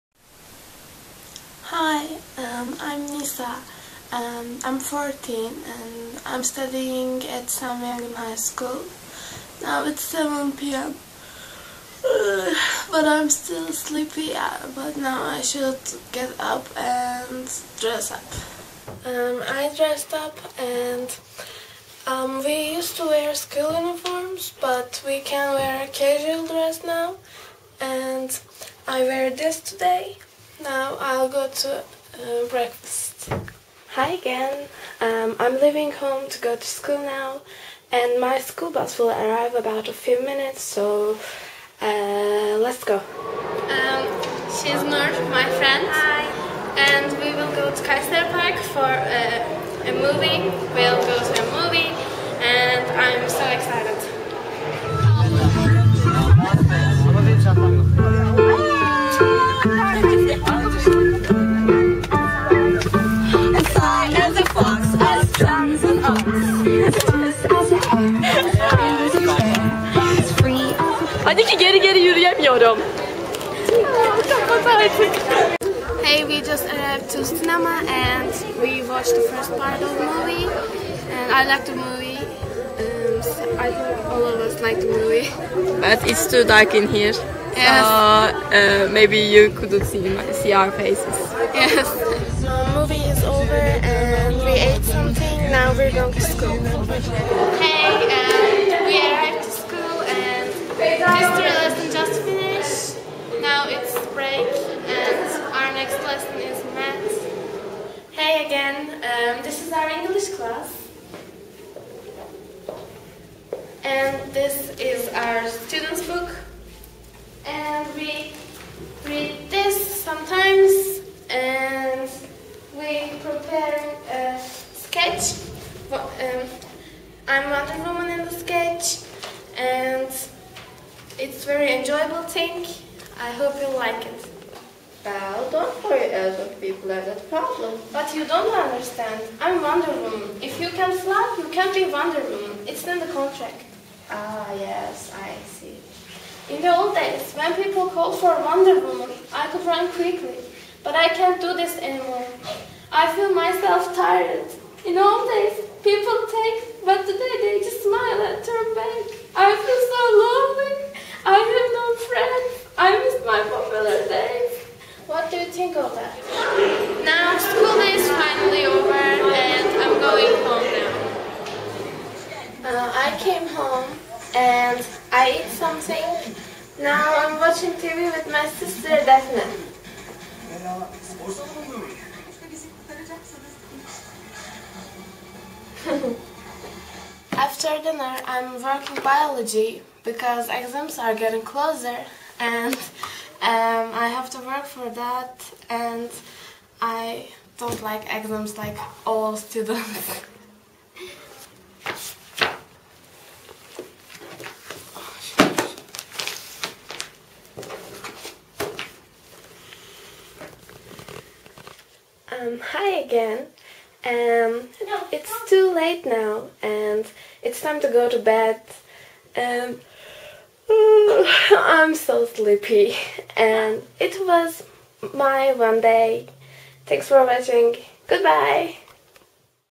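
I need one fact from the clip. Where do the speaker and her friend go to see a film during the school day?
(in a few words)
Kayseri Park.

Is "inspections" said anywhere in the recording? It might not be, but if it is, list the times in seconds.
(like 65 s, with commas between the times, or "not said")
not said.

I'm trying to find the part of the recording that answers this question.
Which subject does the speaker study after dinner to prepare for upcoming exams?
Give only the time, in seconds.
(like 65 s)
189 s.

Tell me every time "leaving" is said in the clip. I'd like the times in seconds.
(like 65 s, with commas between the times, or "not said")
35 s.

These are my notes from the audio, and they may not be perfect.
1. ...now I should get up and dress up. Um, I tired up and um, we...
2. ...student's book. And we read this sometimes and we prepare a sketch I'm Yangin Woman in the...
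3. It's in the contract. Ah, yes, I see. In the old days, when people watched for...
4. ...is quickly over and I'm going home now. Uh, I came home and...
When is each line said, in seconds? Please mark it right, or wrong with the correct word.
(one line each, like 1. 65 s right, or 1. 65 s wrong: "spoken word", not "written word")
1. 14 s wrong: "dressed", not "tired"
2. 115 s wrong: "Wonder", not "Yangin"
3. 142 s wrong: "called", not "watched"
4. 167 s wrong: "finally", not "quickly".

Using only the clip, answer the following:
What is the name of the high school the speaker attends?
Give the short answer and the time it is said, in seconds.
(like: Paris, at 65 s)
Sami Yangin High School, at 7 s.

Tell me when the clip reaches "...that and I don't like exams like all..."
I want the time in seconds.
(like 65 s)
194 s.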